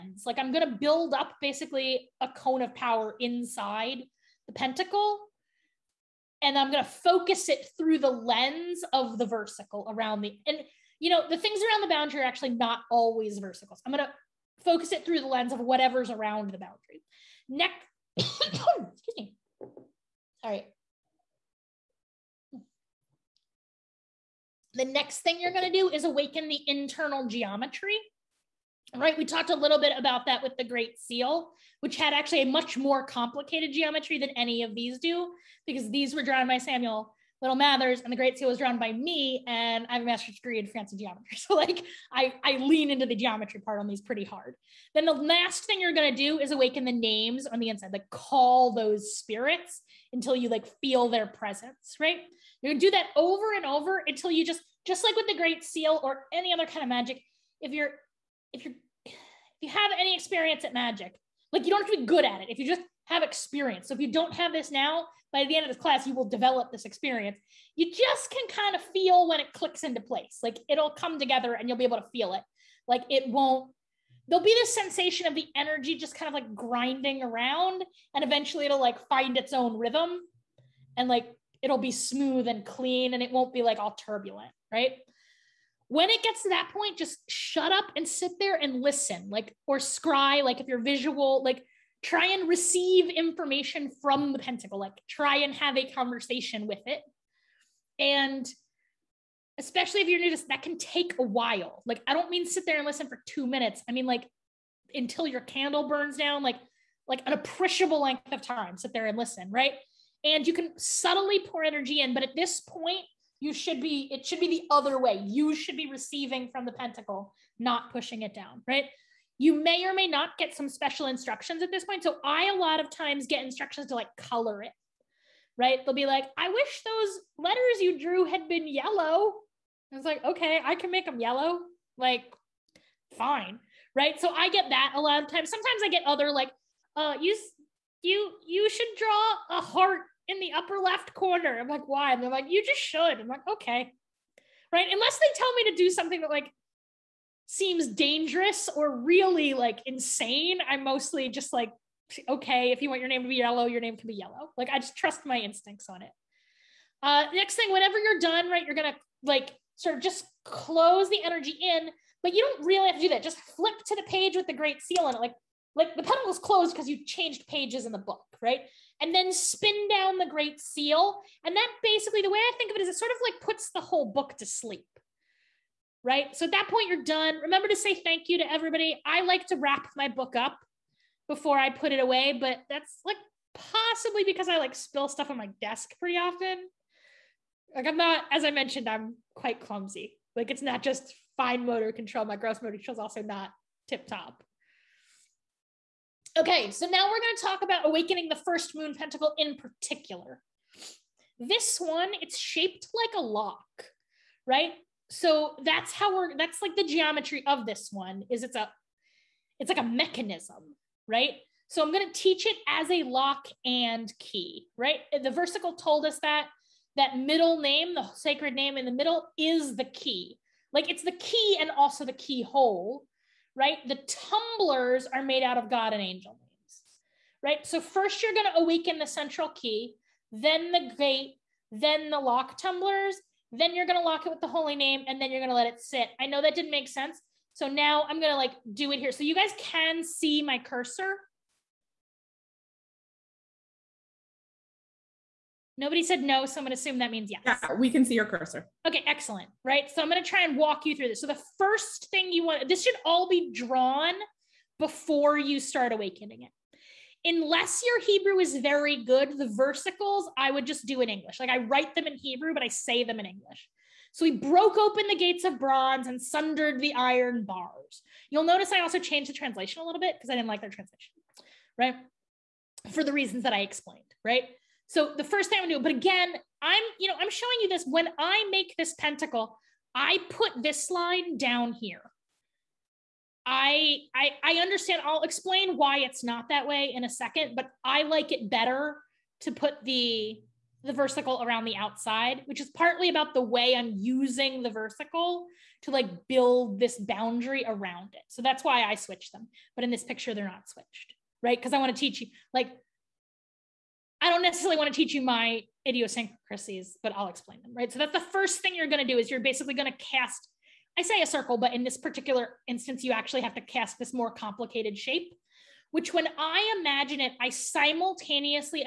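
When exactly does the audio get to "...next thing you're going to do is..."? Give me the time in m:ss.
0:24.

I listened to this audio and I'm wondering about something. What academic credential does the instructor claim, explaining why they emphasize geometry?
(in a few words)
A master's degree.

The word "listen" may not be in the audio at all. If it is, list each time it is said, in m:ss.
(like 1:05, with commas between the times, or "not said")
1:28, 1:42, 1:49.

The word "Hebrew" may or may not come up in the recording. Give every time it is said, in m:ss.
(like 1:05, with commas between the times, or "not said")
4:18, 4:22.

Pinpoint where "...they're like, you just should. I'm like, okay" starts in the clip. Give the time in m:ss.
2:22.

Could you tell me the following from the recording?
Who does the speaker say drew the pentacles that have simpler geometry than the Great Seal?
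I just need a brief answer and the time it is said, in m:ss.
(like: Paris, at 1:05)
Samuel Liddell Mathers, at 0:36.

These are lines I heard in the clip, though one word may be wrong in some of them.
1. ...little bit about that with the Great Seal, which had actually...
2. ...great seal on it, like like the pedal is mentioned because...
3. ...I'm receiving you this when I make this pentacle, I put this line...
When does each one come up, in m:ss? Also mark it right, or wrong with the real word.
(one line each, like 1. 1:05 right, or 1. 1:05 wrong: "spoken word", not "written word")
1. 0:29 right
2. 2:44 wrong: "closed", not "mentioned"
3. 4:37 wrong: "showing", not "receiving".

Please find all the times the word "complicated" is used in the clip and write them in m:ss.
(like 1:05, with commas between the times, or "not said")
0:33, 5:14.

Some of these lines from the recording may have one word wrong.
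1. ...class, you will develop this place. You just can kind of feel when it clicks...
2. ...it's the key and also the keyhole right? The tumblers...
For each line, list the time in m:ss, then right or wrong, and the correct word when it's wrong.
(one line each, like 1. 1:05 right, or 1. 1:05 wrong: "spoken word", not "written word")
1. 1:05 wrong: "experience", not "place"
2. 3:40 right.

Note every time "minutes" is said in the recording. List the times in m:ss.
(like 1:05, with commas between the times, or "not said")
1:43.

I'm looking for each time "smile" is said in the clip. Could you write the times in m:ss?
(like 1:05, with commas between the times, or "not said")
not said.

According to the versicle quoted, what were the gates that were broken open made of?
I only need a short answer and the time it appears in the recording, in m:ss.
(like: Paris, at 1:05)
Bronze, at 4:25.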